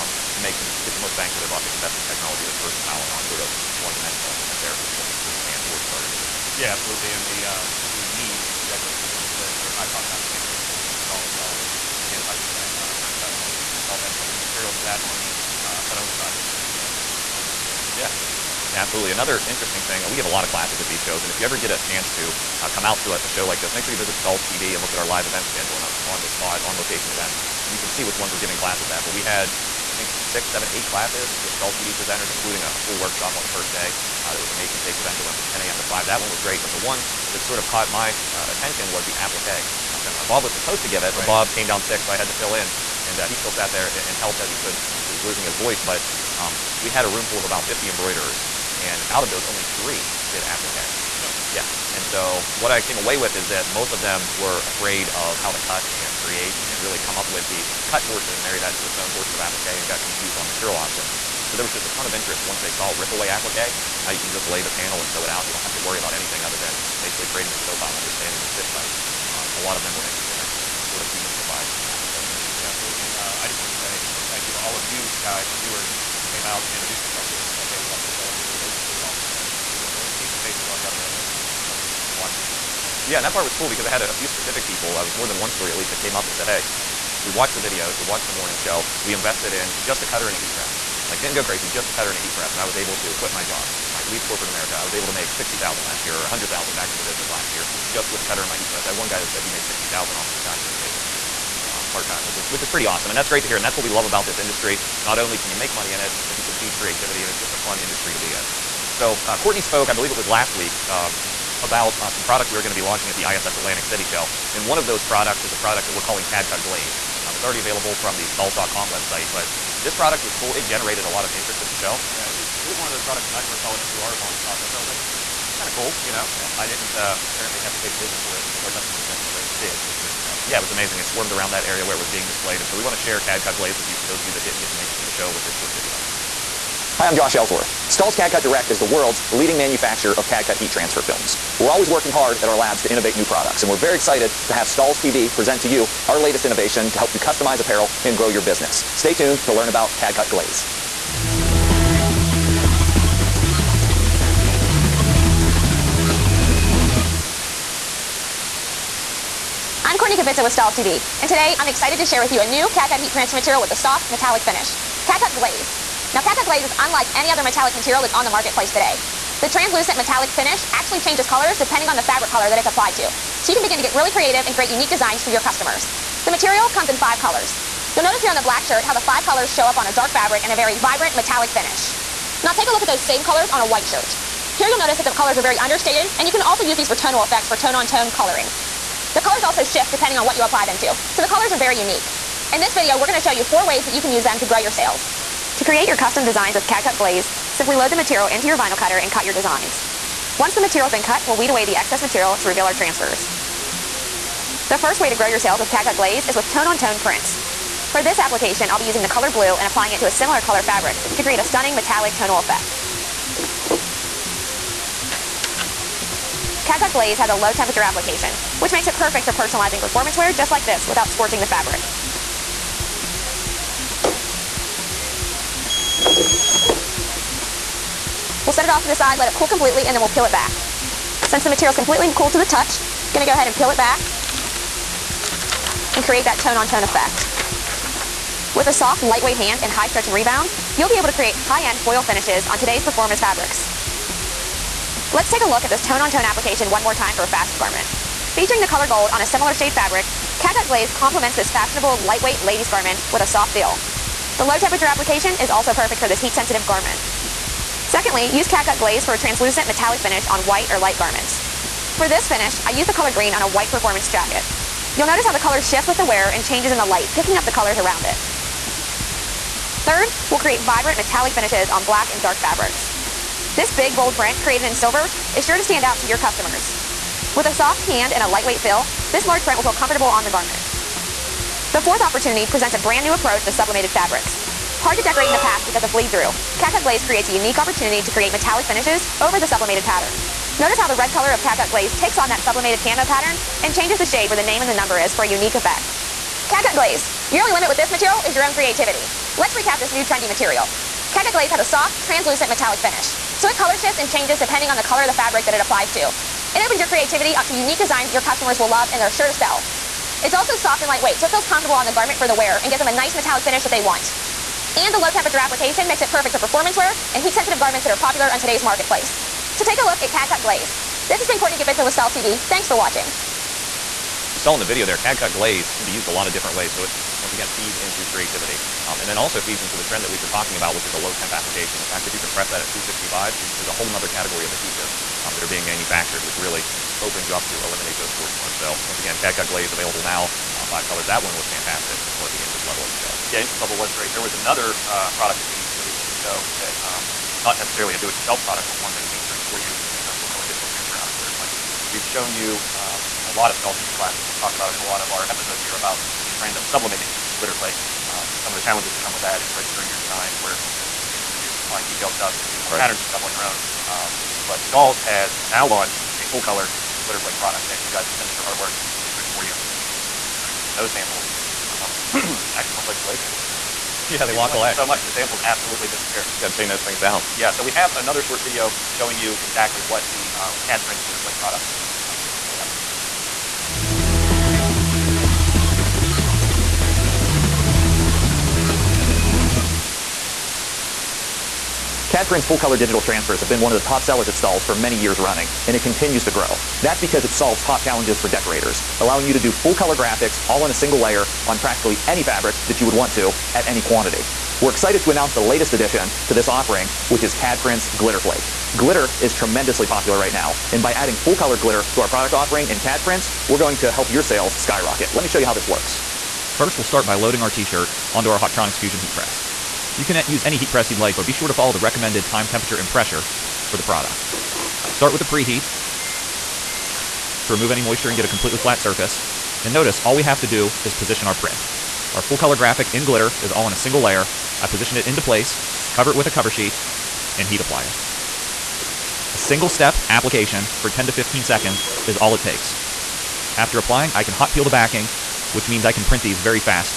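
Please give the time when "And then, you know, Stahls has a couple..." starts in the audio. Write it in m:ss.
0:13.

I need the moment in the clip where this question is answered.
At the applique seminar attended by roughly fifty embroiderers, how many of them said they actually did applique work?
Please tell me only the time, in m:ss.
0:49.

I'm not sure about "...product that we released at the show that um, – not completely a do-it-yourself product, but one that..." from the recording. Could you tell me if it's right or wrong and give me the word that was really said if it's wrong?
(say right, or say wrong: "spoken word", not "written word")
wrong: "necessarily", not "completely".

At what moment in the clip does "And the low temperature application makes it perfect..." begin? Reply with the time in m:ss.
5:14.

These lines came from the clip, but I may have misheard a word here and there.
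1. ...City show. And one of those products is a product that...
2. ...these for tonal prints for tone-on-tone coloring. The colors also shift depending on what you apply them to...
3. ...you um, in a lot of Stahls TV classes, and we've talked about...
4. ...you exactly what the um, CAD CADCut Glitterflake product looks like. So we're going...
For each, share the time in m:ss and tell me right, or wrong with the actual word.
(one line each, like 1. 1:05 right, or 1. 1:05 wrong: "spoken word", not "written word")
1. 1:53 right
2. 3:06 wrong: "effects", not "prints"
3. 5:52 right
4. 6:19 wrong: "Prints", not "CADCut".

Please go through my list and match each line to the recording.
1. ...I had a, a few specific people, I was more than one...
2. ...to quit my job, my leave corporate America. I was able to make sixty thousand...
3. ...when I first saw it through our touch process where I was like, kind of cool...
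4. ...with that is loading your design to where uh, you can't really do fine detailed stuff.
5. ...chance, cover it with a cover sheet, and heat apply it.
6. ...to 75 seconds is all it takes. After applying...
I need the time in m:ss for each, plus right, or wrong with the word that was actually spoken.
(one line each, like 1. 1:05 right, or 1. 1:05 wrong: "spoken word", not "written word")
1. 1:23 right
2. 1:33 right
3. 2:03 wrong: "launch", not "touch"
4. 5:59 wrong: "registering", not "loading"
5. 7:15 wrong: "place", not "chance"
6. 7:21 wrong: "15", not "75".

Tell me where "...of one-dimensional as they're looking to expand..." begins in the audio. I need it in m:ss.
0:03.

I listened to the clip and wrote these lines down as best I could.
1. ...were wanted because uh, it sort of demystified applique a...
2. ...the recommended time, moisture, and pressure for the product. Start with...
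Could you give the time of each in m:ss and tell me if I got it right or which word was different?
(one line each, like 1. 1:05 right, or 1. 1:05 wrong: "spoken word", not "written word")
1. 1:09 wrong: "interested", not "wanted"
2. 7:01 wrong: "temperature", not "moisture".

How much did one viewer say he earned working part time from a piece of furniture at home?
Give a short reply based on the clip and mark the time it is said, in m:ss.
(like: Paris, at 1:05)
$60,000, at 1:39.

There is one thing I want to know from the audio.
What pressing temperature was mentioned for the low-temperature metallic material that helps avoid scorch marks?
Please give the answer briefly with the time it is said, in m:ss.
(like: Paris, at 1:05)
265, at 5:32.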